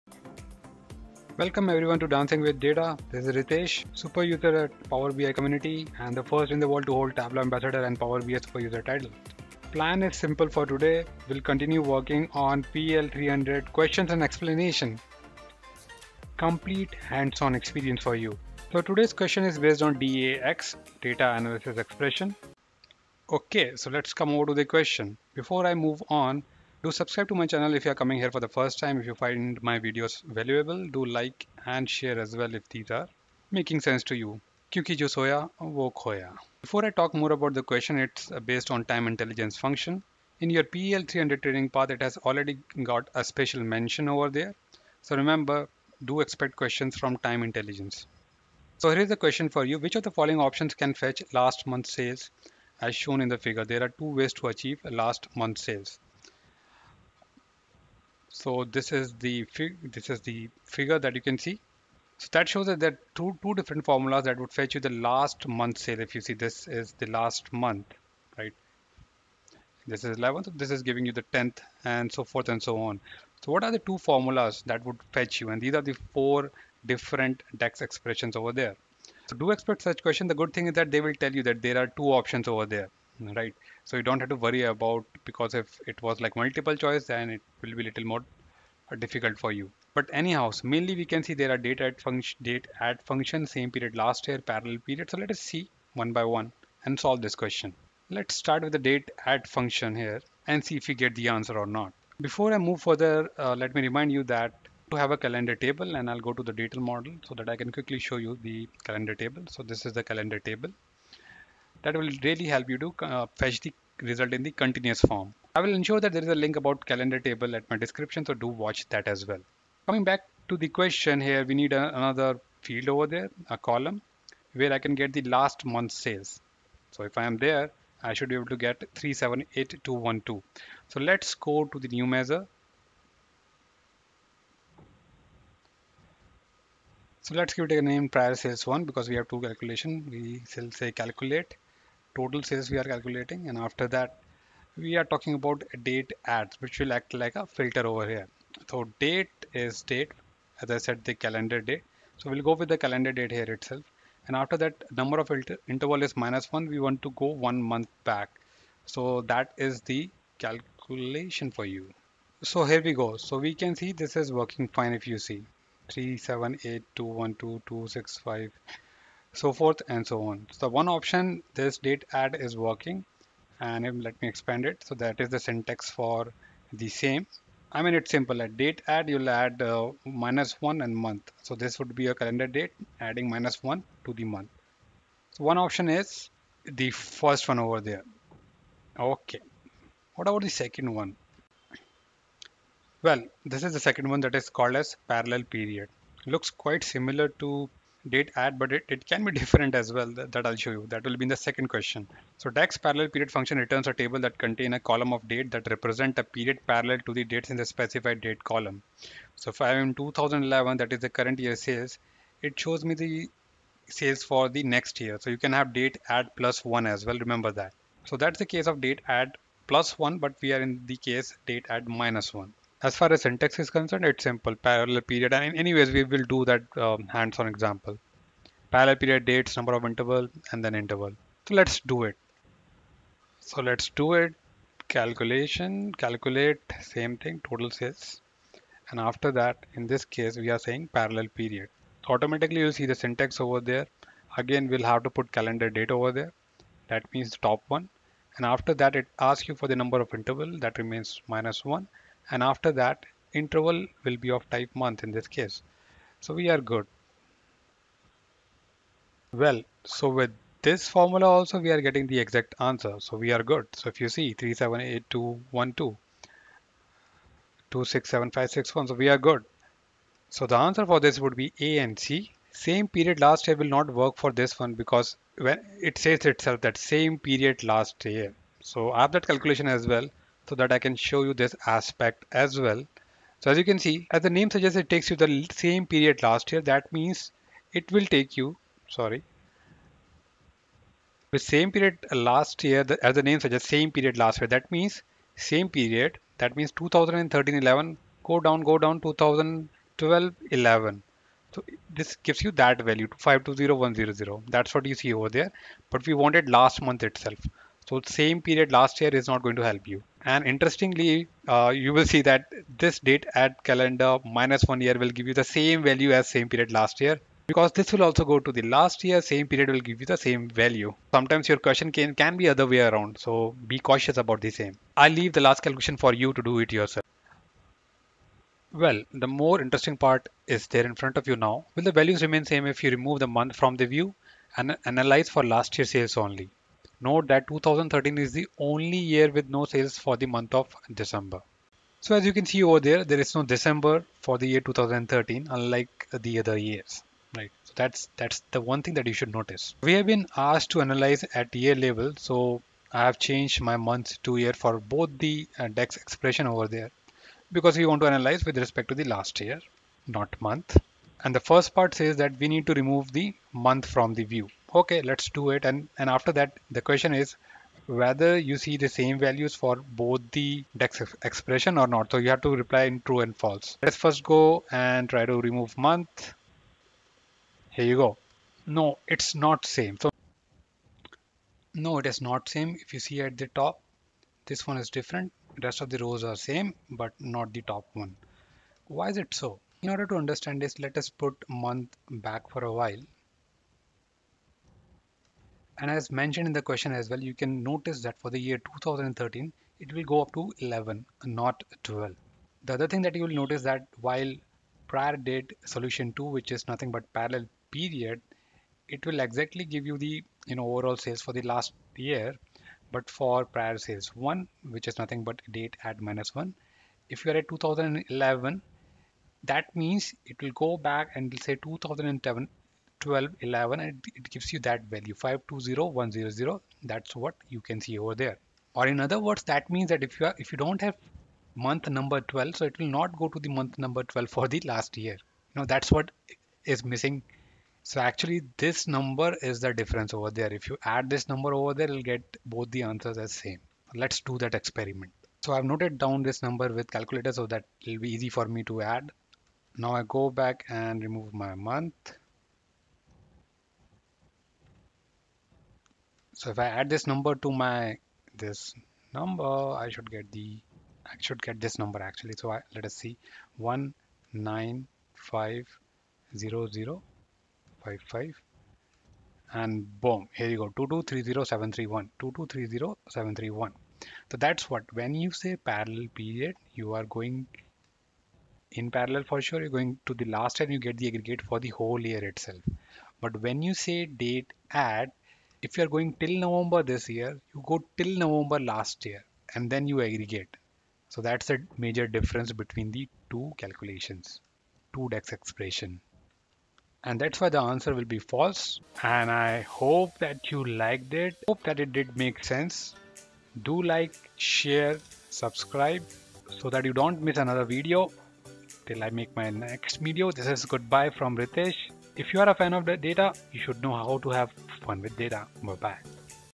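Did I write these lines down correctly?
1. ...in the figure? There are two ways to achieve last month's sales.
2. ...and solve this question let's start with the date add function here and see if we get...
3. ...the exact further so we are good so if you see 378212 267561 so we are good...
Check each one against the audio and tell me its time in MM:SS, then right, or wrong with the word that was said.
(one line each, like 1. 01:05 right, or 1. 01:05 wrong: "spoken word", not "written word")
1. 00:53 right
2. 01:36 right
3. 04:22 wrong: "answer", not "further".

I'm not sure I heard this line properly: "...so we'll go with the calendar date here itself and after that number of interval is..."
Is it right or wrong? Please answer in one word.
right.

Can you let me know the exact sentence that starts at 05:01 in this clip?
So this gives you that value 520100.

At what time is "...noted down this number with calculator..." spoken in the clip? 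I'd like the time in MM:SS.
07:25.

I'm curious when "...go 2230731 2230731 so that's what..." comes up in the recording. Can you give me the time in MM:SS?
07:50.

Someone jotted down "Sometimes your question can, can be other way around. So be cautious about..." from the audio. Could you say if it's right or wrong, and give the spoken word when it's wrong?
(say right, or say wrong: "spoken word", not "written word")
right.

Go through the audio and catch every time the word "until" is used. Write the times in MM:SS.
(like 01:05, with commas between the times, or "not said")
not said.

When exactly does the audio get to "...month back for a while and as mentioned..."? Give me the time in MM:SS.
06:31.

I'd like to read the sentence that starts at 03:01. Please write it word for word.
So this would be a calendar date adding minus one to the month.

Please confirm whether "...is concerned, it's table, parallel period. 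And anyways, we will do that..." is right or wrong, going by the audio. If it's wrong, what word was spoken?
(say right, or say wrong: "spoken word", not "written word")
wrong: "simple", not "table".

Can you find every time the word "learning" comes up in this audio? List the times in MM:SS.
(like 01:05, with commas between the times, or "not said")
not said.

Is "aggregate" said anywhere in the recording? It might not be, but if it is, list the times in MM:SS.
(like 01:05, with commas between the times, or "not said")
08:01, 08:10.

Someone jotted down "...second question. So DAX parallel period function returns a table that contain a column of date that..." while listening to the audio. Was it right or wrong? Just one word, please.
right.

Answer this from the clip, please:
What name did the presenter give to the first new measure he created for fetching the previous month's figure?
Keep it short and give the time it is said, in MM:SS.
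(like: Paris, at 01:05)
prior sales one, at 02:18.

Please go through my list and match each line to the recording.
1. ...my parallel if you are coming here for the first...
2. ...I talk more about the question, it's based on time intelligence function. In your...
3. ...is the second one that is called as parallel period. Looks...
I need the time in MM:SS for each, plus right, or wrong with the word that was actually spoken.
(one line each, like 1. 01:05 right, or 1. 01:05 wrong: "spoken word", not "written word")
1. 00:27 wrong: "channel", not "parallel"
2. 00:36 right
3. 03:13 right.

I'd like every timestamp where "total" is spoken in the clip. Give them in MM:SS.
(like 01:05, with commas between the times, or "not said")
02:22, 03:57.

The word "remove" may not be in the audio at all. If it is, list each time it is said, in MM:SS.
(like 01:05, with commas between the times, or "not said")
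05:32, 06:02, 06:15, 07:31.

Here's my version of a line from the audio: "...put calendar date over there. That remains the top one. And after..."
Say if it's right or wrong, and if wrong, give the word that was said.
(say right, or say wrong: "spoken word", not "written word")
wrong: "means", not "remains".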